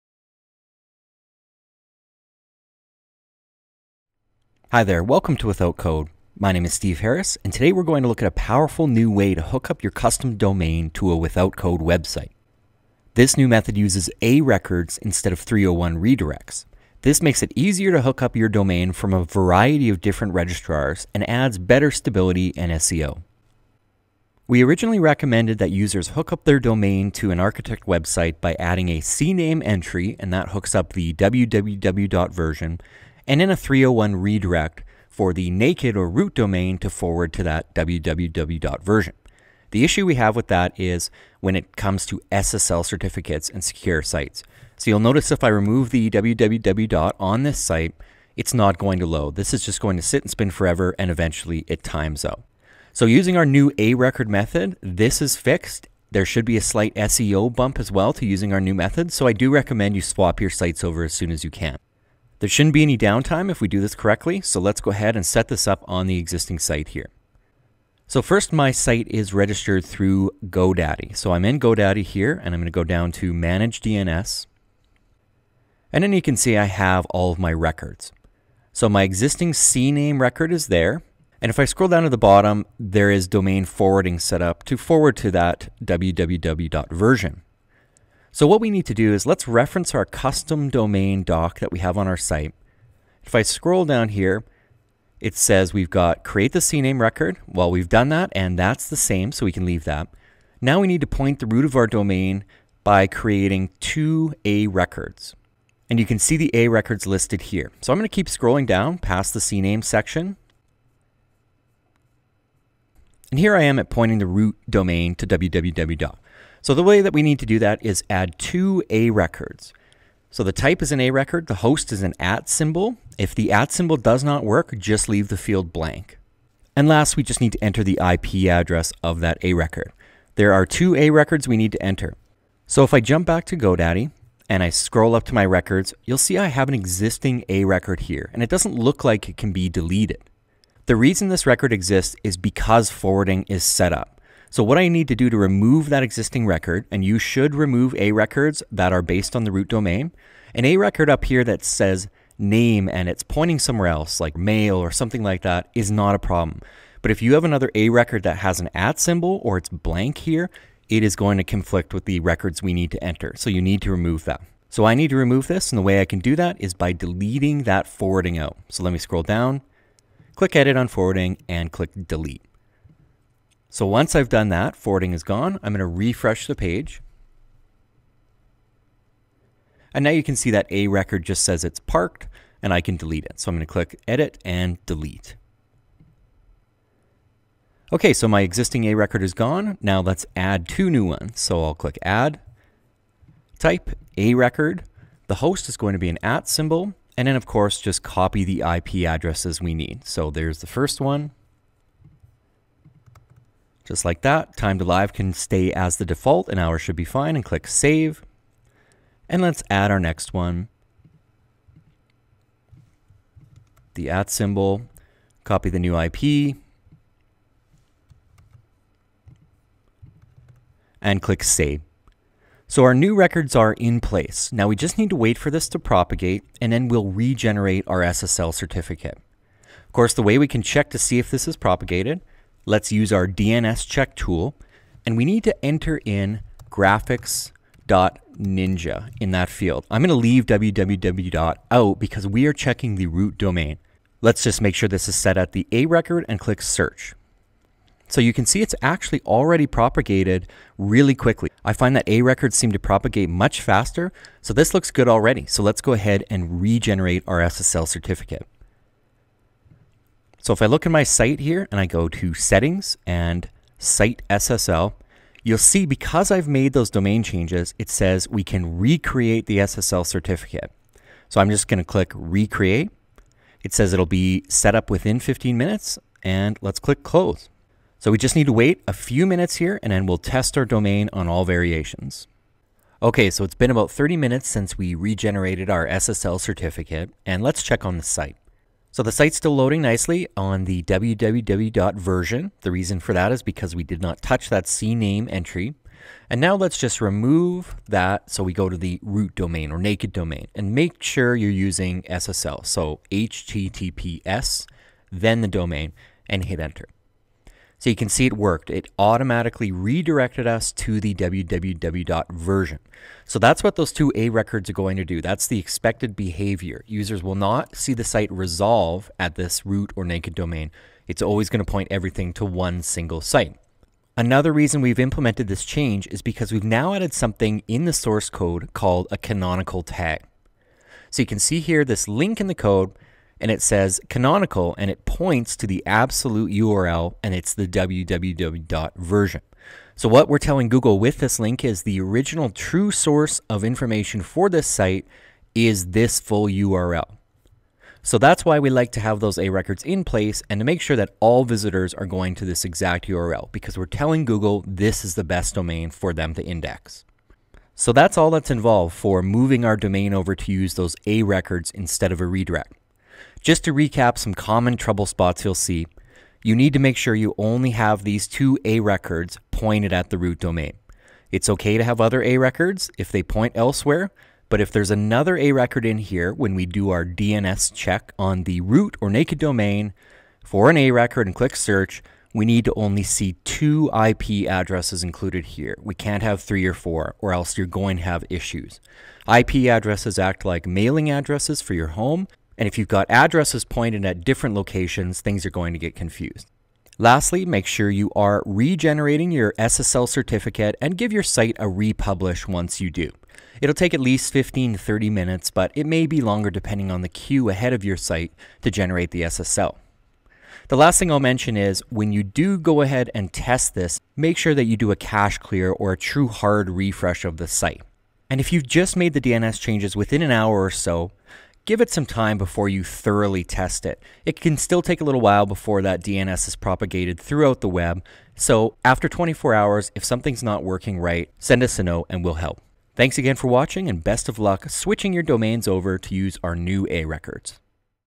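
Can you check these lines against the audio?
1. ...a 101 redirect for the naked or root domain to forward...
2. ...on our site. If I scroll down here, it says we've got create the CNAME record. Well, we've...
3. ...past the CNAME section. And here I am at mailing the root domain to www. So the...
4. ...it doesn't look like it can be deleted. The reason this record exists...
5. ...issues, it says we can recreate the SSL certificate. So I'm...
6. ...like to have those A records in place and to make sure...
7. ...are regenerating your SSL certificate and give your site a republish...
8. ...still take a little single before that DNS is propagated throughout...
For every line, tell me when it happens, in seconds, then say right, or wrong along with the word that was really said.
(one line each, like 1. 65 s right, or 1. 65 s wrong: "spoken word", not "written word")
1. 33 s wrong: "301", not "101"
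2. 91 s right
3. 108 s wrong: "pointing", not "mailing"
4. 138 s right
5. 267 s wrong: "changes", not "issues"
6. 348 s right
7. 398 s right
8. 424 s wrong: "while", not "single".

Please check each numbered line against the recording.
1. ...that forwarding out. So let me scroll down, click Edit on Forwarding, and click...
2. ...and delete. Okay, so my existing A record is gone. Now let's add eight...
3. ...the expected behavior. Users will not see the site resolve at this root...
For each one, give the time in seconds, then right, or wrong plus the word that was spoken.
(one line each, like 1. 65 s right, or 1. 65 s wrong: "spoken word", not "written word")
1. 167 s right
2. 184 s wrong: "two", not "eight"
3. 315 s right.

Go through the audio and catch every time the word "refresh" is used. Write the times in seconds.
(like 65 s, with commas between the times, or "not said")
175 s, 416 s.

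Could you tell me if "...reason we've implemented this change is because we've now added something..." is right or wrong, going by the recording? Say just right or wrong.
right.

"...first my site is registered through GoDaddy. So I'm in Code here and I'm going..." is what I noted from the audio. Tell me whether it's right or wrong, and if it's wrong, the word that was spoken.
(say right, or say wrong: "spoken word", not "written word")
wrong: "GoDaddy", not "Code".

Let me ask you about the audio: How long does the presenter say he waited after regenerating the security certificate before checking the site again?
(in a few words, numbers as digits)
30 minutes.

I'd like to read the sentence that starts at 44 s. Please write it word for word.
So you'll notice if I remove the www on this site, it's not going to load.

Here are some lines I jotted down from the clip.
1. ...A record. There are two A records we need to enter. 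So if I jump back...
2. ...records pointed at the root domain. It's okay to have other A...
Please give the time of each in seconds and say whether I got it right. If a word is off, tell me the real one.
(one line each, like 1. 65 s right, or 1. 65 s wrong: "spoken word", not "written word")
1. 129 s right
2. 368 s right.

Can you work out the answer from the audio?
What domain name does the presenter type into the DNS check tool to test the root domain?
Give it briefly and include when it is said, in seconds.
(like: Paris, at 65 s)
graphics.ninja, at 236 s.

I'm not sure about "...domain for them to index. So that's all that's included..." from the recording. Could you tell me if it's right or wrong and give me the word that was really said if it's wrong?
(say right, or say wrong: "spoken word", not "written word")
wrong: "involved", not "included".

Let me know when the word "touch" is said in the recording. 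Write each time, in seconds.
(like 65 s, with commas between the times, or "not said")
294 s.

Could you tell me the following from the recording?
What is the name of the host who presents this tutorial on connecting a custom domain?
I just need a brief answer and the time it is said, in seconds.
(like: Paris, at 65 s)
Steve Harris, at 6 s.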